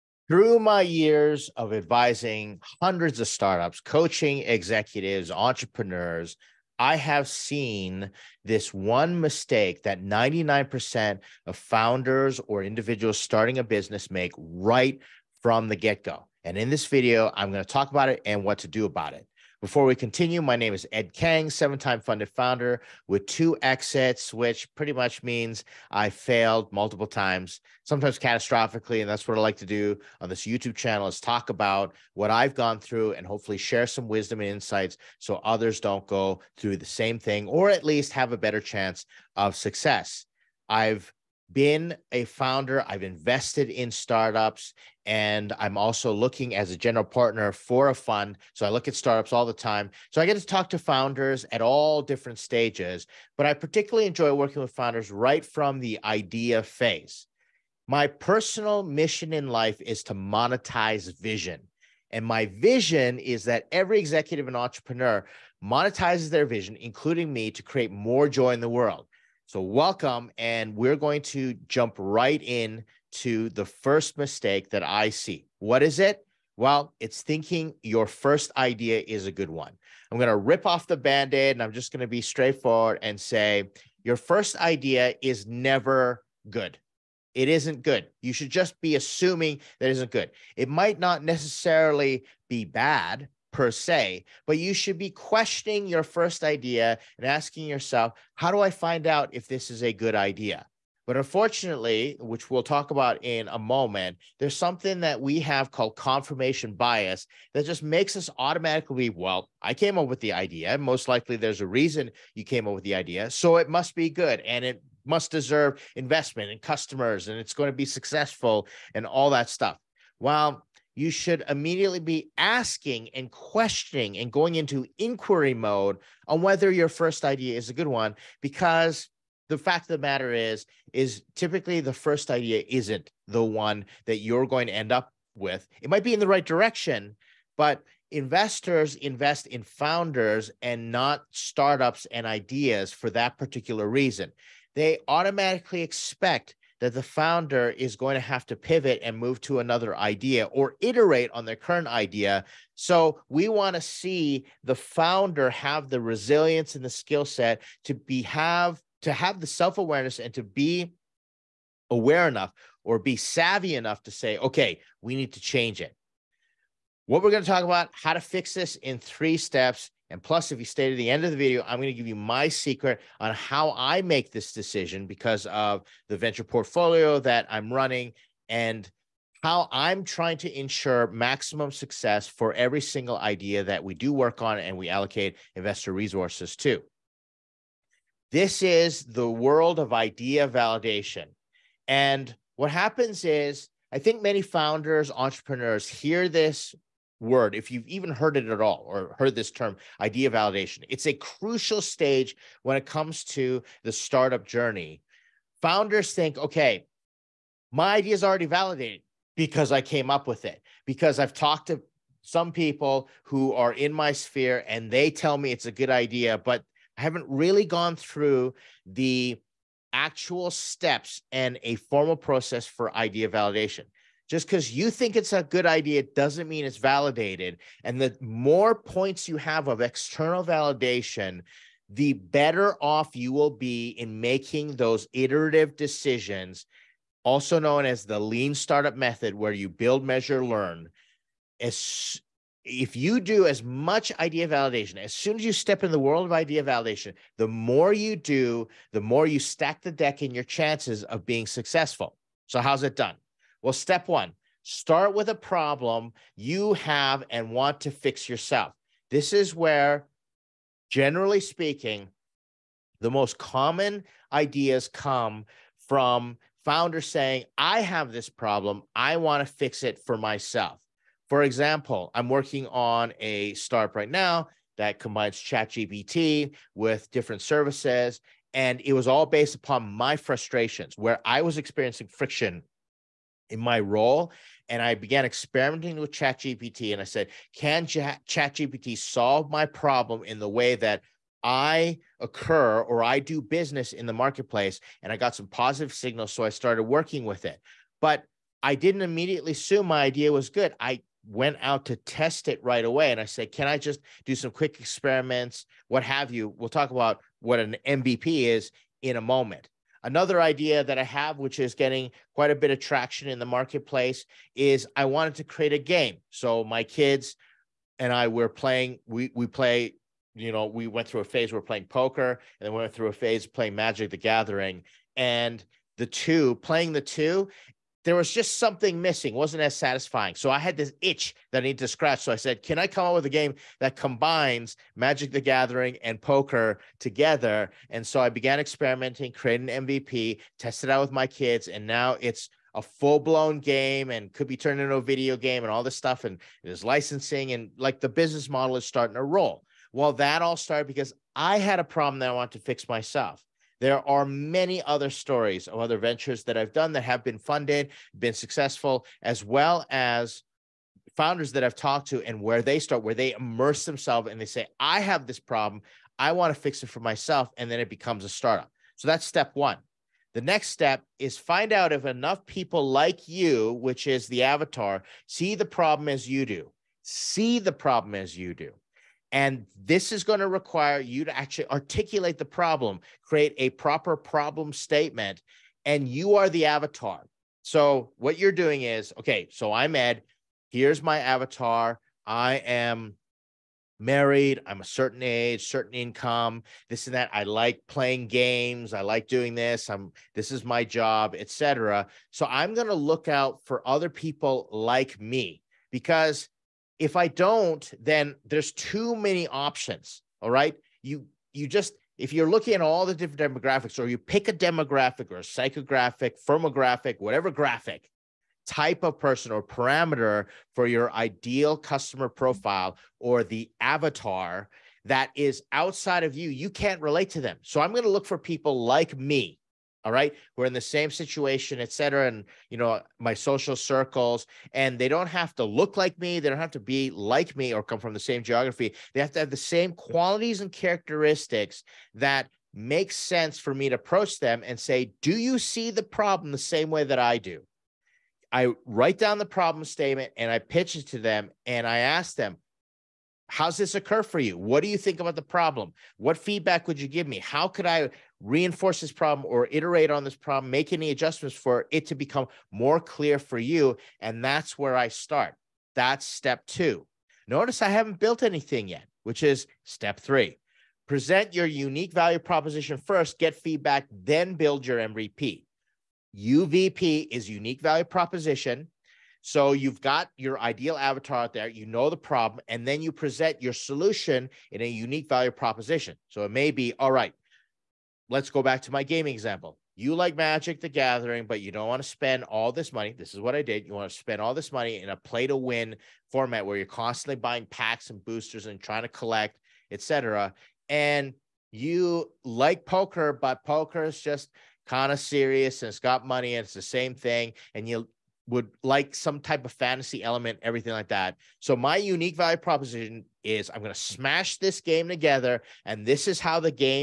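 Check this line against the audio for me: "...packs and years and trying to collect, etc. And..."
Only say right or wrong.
wrong.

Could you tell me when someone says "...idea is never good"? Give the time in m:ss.
1:24.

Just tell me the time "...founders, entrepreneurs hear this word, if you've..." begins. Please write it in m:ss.
3:14.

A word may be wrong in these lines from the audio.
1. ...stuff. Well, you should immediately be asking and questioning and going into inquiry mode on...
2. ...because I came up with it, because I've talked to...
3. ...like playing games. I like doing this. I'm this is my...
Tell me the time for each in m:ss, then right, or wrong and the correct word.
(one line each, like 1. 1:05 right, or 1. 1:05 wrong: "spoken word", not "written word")
1. 1:59 right
2. 3:29 right
3. 6:37 right.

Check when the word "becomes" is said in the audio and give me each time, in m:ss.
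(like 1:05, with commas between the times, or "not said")
6:07, 7:42.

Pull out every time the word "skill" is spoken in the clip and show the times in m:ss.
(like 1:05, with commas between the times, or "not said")
2:36.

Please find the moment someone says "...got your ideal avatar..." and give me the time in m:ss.
8:00.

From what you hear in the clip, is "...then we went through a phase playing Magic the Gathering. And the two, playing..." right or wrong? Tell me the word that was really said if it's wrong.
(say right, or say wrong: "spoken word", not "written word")
right.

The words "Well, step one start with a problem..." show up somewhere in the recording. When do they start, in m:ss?
4:13.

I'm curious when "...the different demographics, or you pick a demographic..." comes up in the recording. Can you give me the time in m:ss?
6:53.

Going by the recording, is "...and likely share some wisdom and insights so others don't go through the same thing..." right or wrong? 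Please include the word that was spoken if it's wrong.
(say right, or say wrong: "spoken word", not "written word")
wrong: "hopefully", not "likely".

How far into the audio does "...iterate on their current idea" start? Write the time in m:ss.
2:30.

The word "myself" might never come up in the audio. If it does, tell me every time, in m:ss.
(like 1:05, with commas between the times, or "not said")
4:30, 5:52, 6:07.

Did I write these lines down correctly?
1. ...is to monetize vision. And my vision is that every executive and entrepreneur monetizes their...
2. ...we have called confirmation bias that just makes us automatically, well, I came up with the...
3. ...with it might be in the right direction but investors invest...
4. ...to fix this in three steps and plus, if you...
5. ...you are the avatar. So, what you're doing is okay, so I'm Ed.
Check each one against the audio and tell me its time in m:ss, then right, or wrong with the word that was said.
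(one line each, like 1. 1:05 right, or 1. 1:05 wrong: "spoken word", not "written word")
1. 0:59 right
2. 1:45 right
3. 2:15 right
4. 2:48 right
5. 6:26 right.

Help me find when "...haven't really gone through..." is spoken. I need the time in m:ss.
3:37.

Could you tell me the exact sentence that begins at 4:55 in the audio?
And I got some positive signals.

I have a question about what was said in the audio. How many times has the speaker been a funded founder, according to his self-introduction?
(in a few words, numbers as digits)
7.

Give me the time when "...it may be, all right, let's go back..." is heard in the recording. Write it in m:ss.
8:06.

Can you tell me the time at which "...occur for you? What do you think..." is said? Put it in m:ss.
7:33.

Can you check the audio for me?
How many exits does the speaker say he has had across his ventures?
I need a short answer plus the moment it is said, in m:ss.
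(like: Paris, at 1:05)
2, at 0:23.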